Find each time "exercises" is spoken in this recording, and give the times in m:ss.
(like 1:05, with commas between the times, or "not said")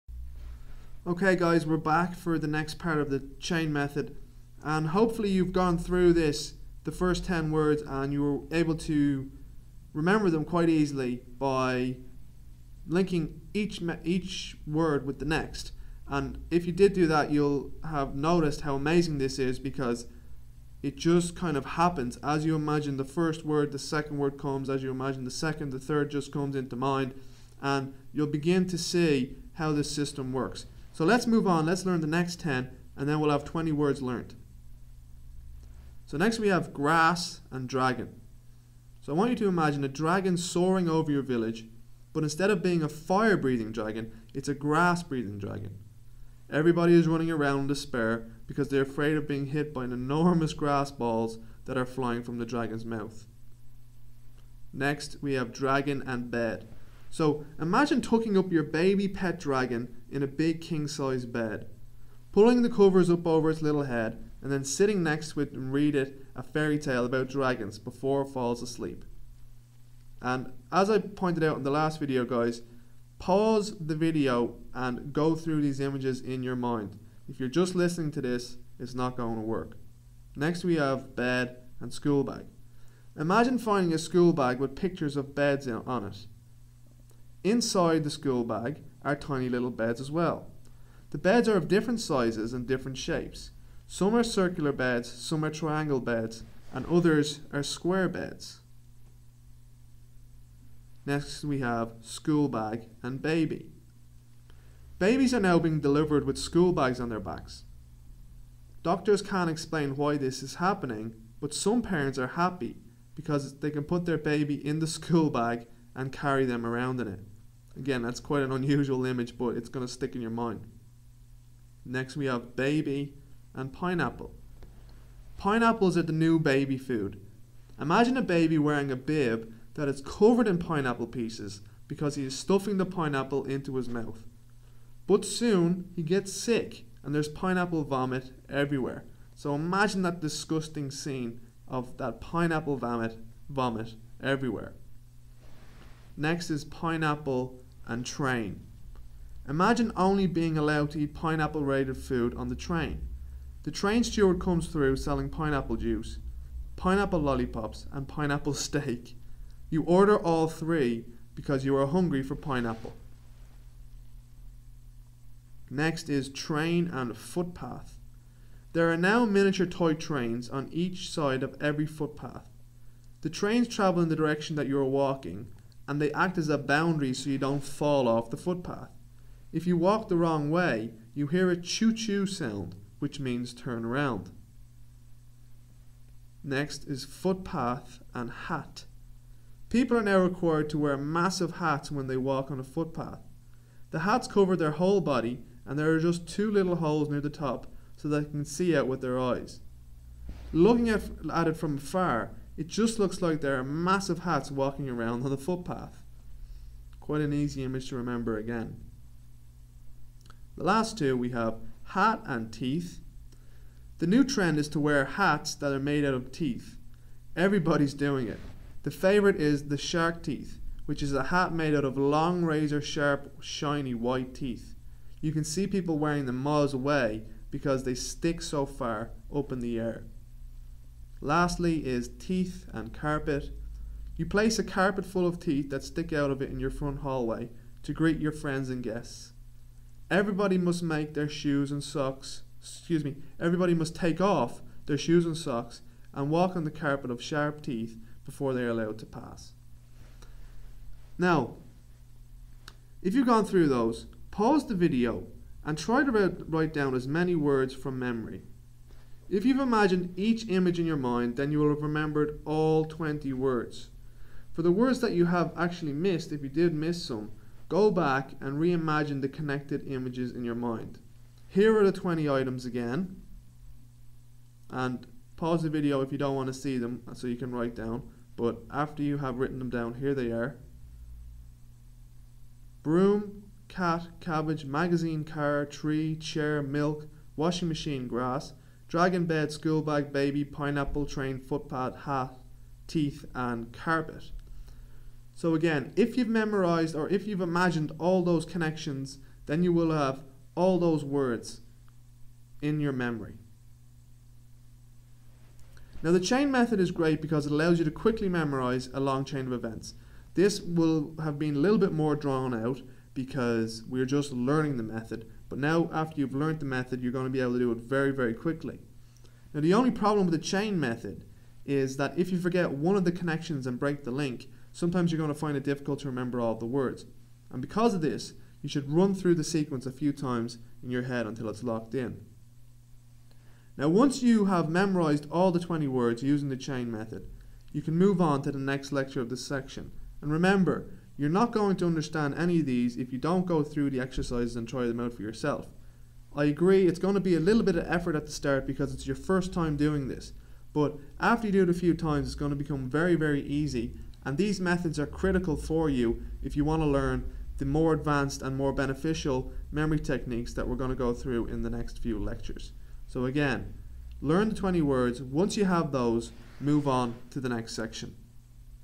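5:43.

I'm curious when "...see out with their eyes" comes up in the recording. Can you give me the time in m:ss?
3:18.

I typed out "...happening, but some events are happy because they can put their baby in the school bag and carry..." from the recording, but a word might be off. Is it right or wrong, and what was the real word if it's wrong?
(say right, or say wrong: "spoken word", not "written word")
wrong: "parents", not "events".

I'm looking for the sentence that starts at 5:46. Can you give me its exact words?
I agree, it's going to be a little bit of effort at the start because it's your first time doing this.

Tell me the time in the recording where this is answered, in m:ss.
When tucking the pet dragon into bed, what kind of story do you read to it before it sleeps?
1:06.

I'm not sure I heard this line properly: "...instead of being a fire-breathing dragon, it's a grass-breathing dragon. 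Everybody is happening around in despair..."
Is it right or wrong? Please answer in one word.
wrong.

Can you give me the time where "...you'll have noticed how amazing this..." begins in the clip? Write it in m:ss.
0:17.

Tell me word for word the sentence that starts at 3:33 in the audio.
The new trend is to wear hats that are made out of teeth.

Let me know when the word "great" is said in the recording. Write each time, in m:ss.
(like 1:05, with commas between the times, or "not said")
5:06.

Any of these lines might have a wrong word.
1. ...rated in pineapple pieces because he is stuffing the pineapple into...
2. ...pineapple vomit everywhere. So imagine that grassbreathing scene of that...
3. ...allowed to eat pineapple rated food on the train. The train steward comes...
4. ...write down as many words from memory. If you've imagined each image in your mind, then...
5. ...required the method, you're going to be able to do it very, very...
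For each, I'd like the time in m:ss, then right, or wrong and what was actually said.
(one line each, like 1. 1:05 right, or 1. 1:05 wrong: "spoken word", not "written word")
1. 2:10 wrong: "covered", not "rated"
2. 2:17 wrong: "disgusting", not "grassbreathing"
3. 2:30 right
4. 4:16 right
5. 5:16 wrong: "learned", not "required".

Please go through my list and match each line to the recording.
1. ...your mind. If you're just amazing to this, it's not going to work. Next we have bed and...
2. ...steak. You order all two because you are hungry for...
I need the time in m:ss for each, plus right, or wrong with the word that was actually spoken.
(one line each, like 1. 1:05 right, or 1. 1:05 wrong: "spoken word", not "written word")
1. 1:16 wrong: "listening", not "amazing"
2. 2:38 wrong: "three", not "two".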